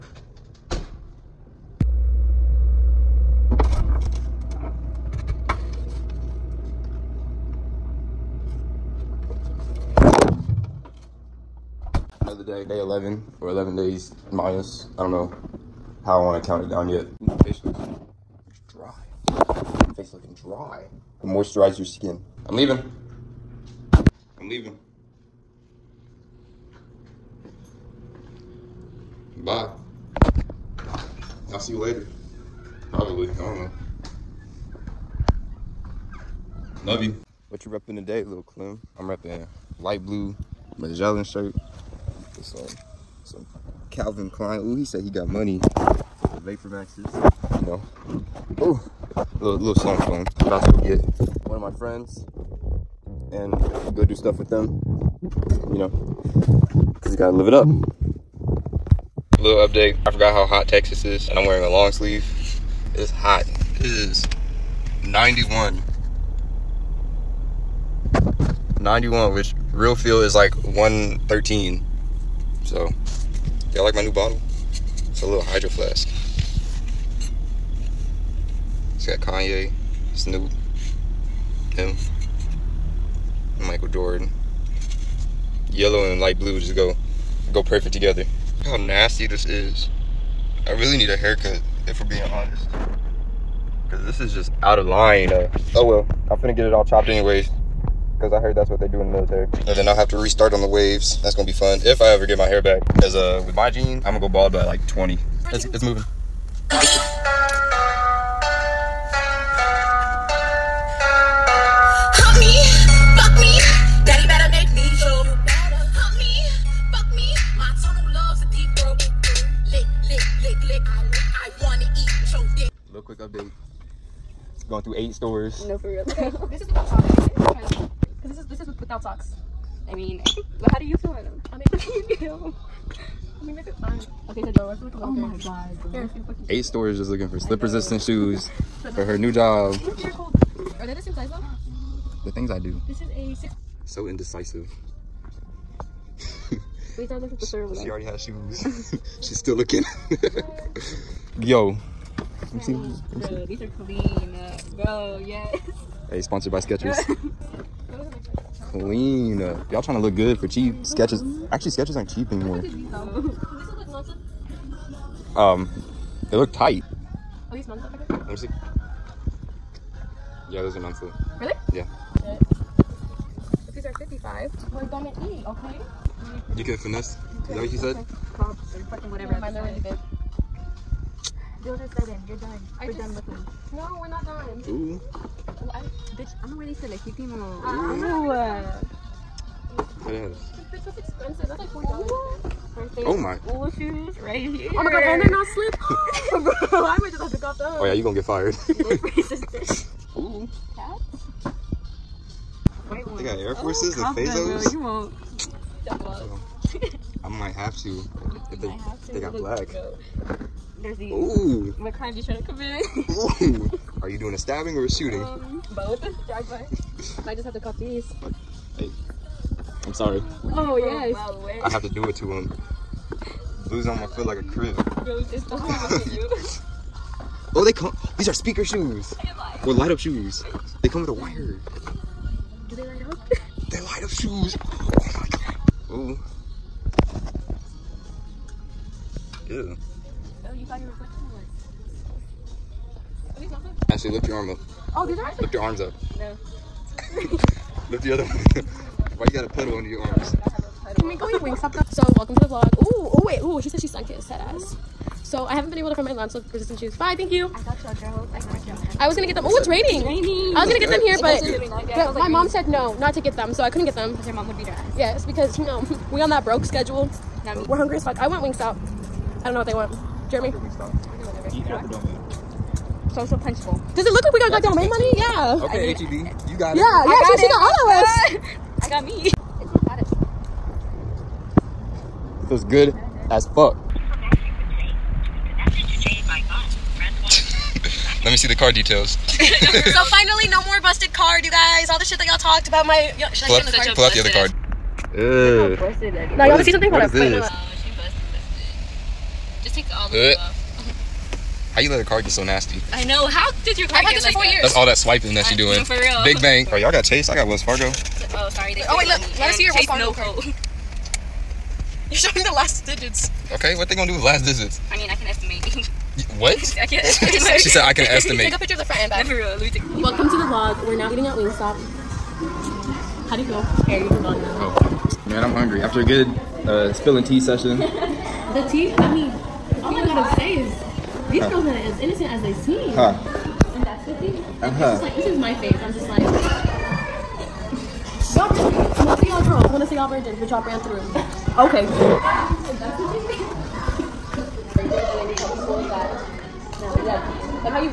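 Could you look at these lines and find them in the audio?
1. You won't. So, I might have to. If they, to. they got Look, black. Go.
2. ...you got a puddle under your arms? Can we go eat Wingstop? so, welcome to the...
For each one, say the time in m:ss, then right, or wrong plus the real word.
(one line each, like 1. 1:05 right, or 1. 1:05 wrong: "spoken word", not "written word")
1. 3:24 right
2. 4:09 right.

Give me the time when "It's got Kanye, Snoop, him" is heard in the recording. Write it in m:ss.
1:18.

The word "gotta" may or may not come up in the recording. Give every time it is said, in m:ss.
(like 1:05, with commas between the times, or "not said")
0:57, 5:30.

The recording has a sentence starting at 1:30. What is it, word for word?
I really need a haircut, if we're being honest.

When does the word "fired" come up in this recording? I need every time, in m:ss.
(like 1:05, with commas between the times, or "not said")
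3:18.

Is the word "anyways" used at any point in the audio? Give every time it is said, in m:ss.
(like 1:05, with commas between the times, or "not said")
1:37.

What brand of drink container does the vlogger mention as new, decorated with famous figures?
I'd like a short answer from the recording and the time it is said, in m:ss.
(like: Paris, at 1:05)
Hydro Flask, at 1:15.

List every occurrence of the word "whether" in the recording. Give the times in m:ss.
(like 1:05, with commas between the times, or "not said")
not said.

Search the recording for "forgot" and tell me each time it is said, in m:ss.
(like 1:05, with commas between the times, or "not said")
1:00.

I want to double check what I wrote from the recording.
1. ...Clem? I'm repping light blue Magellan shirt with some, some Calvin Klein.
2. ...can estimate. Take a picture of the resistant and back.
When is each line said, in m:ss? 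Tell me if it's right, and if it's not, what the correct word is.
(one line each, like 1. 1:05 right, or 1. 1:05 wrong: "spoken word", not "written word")
1. 0:38 right
2. 5:17 wrong: "front", not "resistant".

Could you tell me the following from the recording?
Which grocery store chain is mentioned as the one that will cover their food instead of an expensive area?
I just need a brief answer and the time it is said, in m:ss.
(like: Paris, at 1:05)
HEB, at 4:35.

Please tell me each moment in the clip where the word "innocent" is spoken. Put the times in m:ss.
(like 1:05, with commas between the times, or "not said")
5:31.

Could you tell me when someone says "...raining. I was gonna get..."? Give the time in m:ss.
4:20.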